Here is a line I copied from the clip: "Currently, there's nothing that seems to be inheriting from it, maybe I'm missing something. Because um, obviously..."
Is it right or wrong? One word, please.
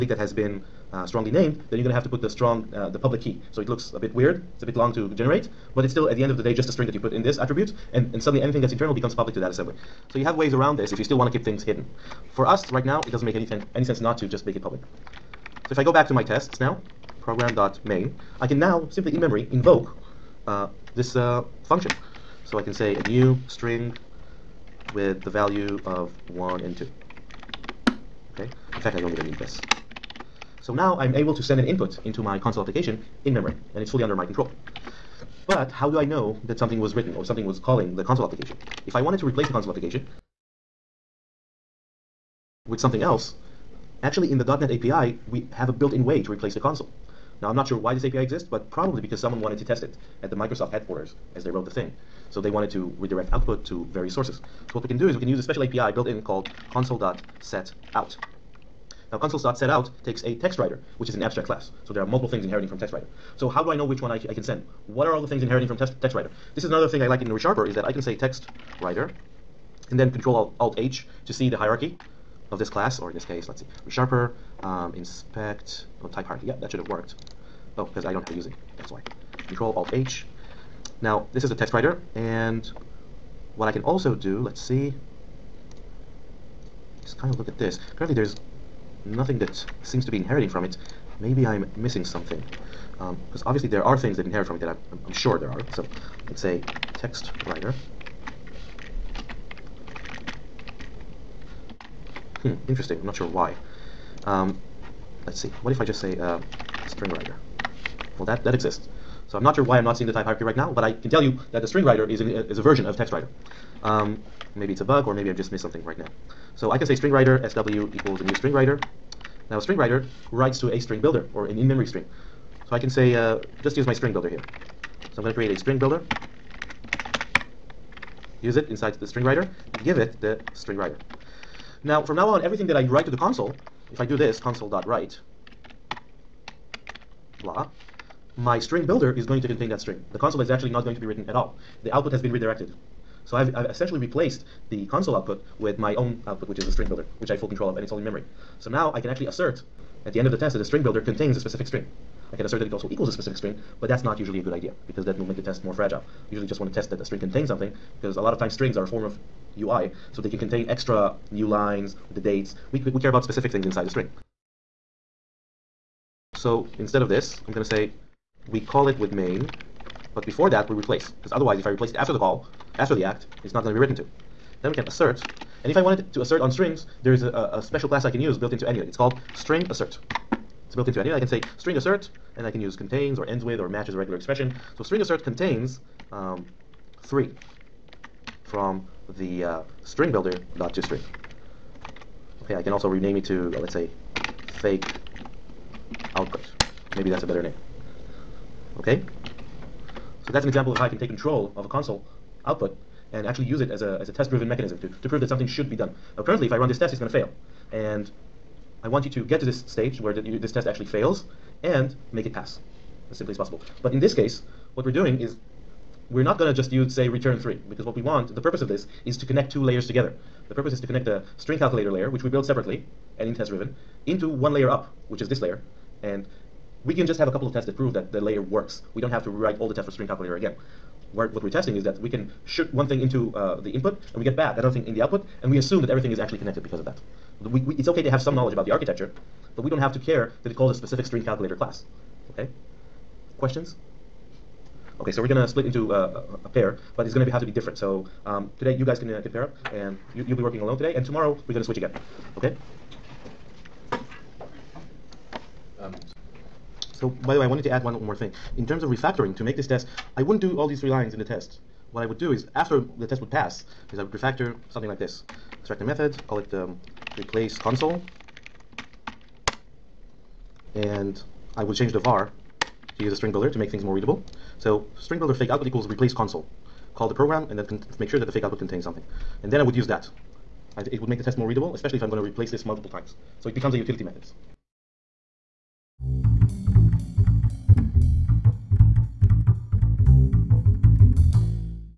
right.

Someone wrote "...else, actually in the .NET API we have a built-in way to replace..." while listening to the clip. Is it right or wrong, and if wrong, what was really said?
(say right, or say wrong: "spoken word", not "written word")
right.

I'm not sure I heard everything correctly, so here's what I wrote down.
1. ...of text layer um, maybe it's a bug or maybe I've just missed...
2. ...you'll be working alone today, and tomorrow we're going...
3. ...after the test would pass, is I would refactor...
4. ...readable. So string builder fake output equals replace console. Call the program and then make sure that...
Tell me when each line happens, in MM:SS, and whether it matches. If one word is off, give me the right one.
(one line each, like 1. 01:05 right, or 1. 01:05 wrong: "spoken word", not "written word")
1. 01:52 wrong: "writer", not "layer"
2. 04:10 right
3. 04:22 right
4. 04:33 right.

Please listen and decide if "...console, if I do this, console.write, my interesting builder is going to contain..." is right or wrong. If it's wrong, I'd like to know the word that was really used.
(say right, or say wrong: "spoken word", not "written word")
wrong: "string", not "interesting".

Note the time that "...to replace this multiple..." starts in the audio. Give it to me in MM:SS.
04:42.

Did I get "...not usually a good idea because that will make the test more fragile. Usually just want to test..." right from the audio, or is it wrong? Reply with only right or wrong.
right.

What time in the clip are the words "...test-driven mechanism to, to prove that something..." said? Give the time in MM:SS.
03:24.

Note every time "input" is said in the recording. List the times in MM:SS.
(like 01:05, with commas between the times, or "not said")
00:31, 03:53.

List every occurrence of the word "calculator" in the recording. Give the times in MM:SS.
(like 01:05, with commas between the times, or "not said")
03:41, 03:50, 04:01.